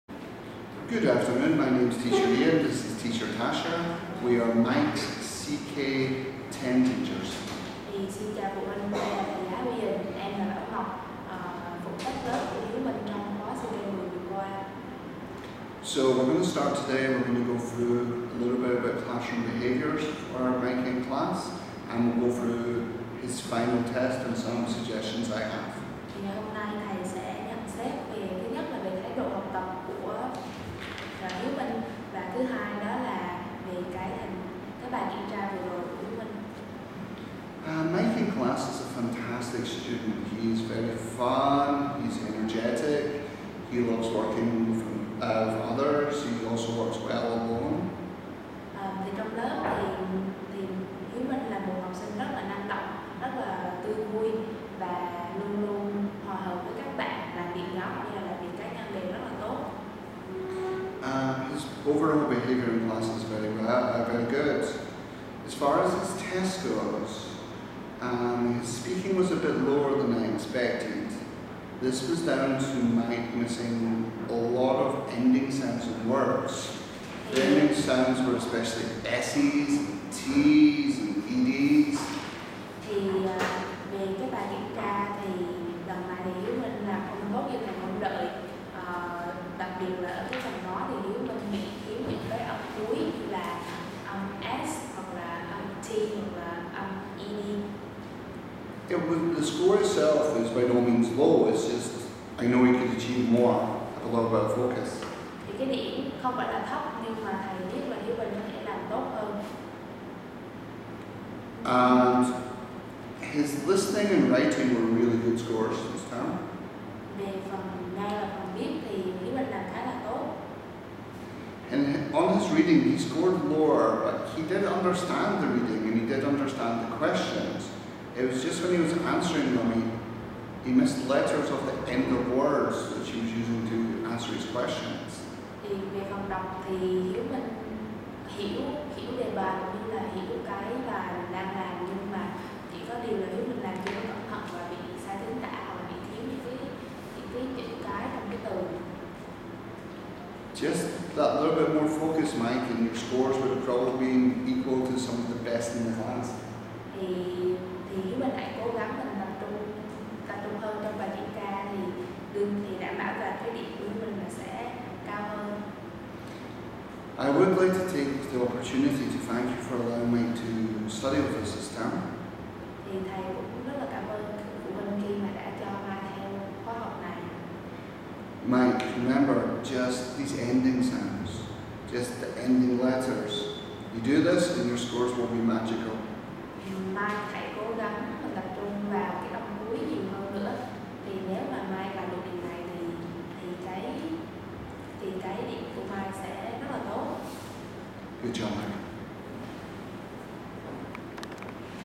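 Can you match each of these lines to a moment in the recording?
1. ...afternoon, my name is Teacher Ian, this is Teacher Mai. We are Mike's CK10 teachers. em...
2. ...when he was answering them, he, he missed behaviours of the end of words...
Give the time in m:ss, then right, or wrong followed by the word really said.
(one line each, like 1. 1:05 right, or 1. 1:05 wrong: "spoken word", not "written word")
1. 0:01 wrong: "Tasha", not "Mai"
2. 2:08 wrong: "letters", not "behaviours".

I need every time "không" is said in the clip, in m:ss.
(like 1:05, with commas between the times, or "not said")
1:26, 1:46.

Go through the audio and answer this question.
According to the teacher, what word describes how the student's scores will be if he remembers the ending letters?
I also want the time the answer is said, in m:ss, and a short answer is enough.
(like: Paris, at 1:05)
magical, at 3:05.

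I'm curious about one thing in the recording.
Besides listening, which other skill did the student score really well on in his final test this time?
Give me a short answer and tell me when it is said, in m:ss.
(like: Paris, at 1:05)
writing, at 1:54.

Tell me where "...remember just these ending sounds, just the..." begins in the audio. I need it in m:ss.
2:59.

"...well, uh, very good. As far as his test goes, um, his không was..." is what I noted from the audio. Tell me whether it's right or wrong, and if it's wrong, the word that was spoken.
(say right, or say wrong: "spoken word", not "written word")
wrong: "speaking", not "không".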